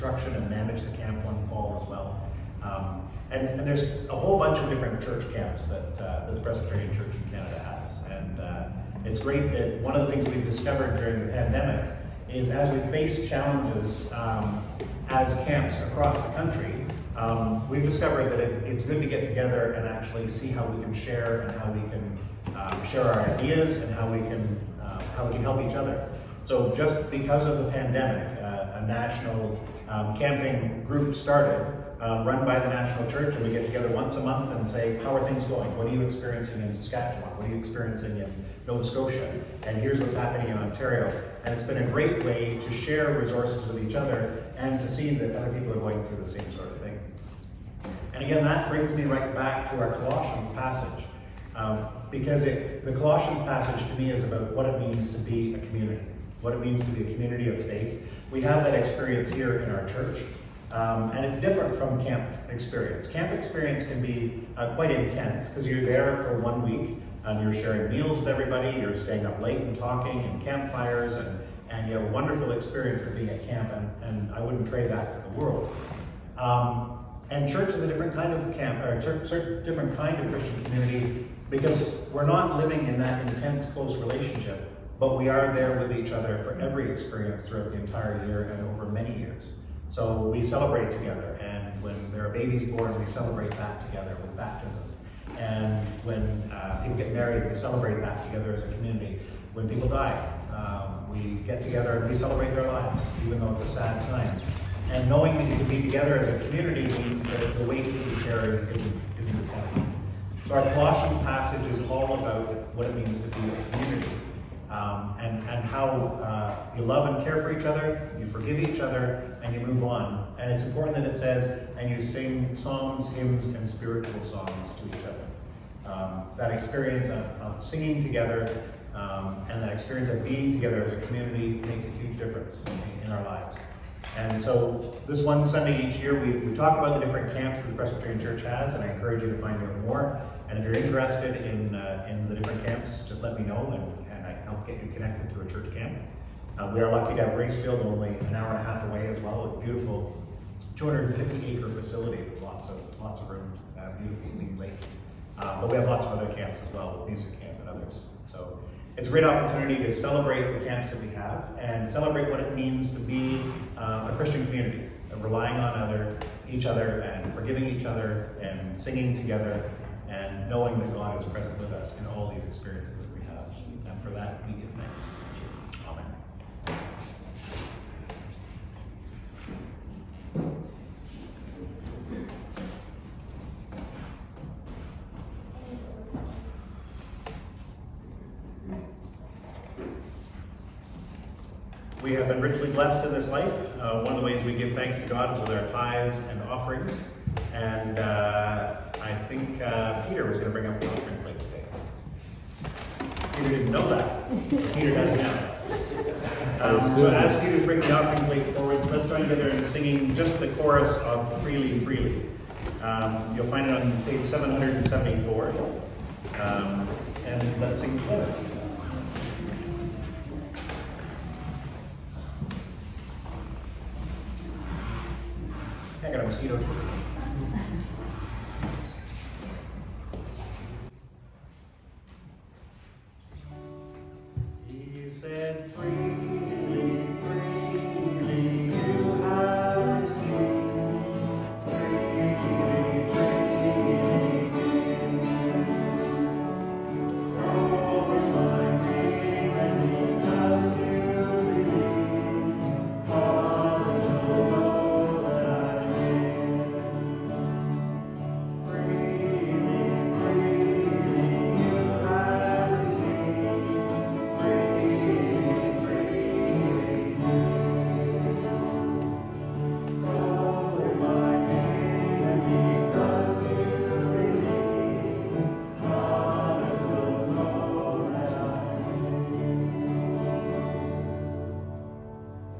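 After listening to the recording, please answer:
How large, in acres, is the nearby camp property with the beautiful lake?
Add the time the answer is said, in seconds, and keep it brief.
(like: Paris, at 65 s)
250, at 150 s.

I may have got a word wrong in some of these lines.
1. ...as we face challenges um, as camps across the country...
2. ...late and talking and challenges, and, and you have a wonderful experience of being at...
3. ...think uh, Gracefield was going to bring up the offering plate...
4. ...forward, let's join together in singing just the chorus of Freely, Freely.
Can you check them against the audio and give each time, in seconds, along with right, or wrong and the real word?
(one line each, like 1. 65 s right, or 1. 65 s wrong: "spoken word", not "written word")
1. 12 s right
2. 69 s wrong: "campfires", not "challenges"
3. 199 s wrong: "Peter", not "Gracefield"
4. 208 s right.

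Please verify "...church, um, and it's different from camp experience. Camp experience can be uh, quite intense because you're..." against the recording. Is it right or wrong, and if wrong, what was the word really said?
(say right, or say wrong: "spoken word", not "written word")
right.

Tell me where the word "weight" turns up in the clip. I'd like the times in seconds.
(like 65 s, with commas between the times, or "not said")
107 s.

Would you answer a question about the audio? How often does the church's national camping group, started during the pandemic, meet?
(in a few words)
Once a month.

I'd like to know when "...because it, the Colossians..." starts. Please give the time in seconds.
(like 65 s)
52 s.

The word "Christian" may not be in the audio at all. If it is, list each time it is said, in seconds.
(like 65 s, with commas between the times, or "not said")
80 s, 164 s.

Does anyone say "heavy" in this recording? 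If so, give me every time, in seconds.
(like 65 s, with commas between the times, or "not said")
109 s.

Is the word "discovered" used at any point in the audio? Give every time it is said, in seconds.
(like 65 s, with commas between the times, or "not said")
10 s, 17 s.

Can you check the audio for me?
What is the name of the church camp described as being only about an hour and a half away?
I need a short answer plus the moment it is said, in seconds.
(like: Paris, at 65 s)
Gracefield, at 147 s.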